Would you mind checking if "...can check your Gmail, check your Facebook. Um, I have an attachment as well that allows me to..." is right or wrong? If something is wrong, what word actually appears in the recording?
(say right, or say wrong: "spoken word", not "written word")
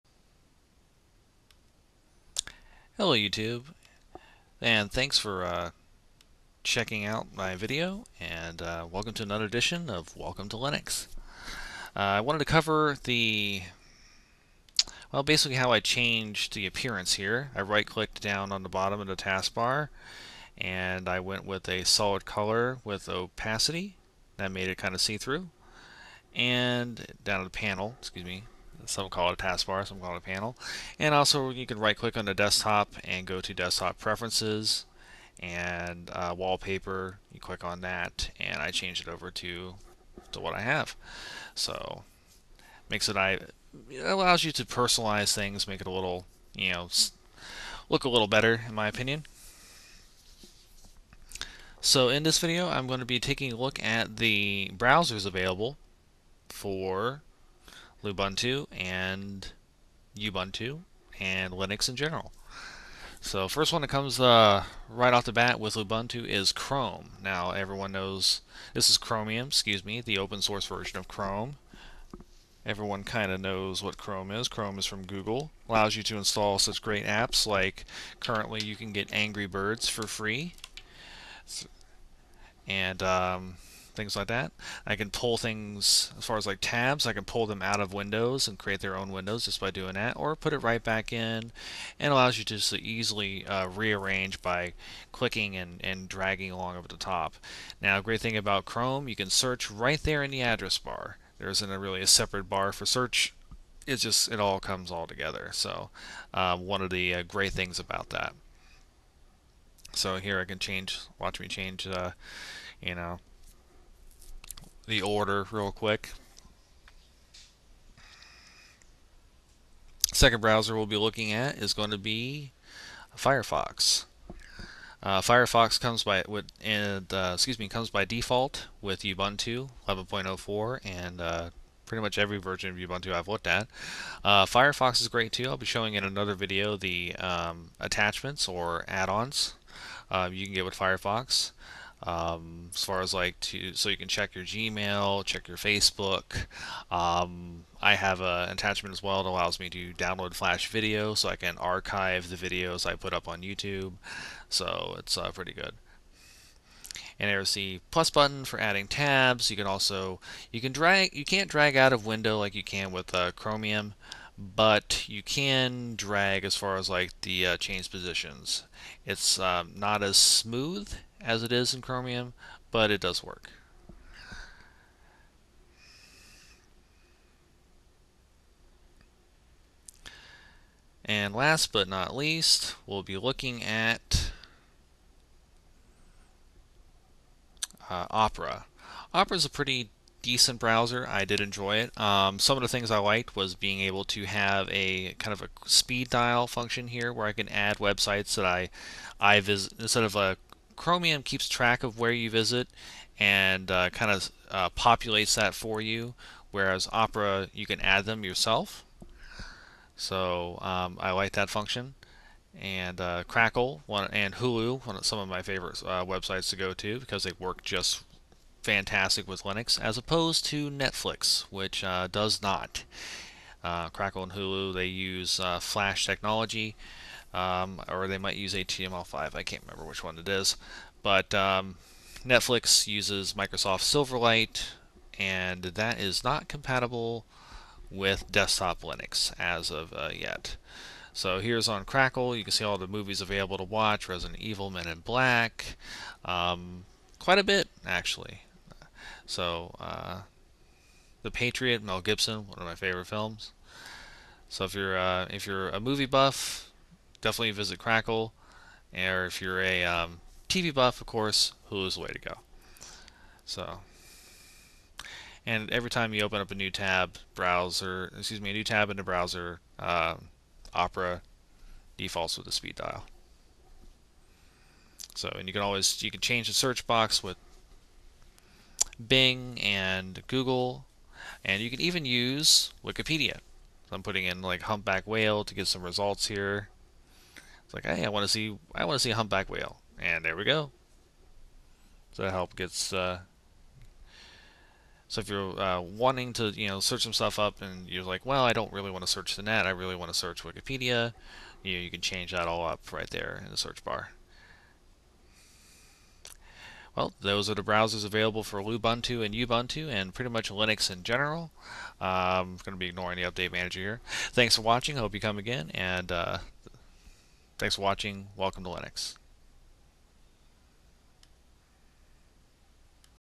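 right.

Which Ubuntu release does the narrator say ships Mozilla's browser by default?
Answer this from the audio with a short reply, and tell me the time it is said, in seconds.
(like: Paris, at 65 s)
11.04, at 129 s.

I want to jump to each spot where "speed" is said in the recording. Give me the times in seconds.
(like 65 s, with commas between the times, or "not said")
195 s, 272 s.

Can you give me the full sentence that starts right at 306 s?
Well, those are the browsers available for Lubuntu and Ubuntu and pretty much Linux in general.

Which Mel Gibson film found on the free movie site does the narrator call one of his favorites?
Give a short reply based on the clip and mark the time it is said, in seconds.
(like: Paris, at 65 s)
The Patriot, at 251 s.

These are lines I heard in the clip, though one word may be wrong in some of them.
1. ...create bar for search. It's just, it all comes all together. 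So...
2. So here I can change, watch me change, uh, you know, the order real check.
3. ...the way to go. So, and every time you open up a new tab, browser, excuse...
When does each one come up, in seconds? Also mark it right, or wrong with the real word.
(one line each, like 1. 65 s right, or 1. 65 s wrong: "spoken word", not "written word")
1. 102 s wrong: "separate", not "create"
2. 109 s wrong: "quick", not "check"
3. 261 s right.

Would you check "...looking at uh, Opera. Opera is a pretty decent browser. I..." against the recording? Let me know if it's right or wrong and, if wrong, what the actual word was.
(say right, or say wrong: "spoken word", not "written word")
right.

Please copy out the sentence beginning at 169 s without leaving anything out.
It's um, not as smooth as it is in Chromium, but it does work.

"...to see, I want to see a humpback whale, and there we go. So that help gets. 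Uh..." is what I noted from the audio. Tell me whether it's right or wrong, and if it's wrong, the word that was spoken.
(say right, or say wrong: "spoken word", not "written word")
right.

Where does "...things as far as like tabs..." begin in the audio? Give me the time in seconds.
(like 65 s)
85 s.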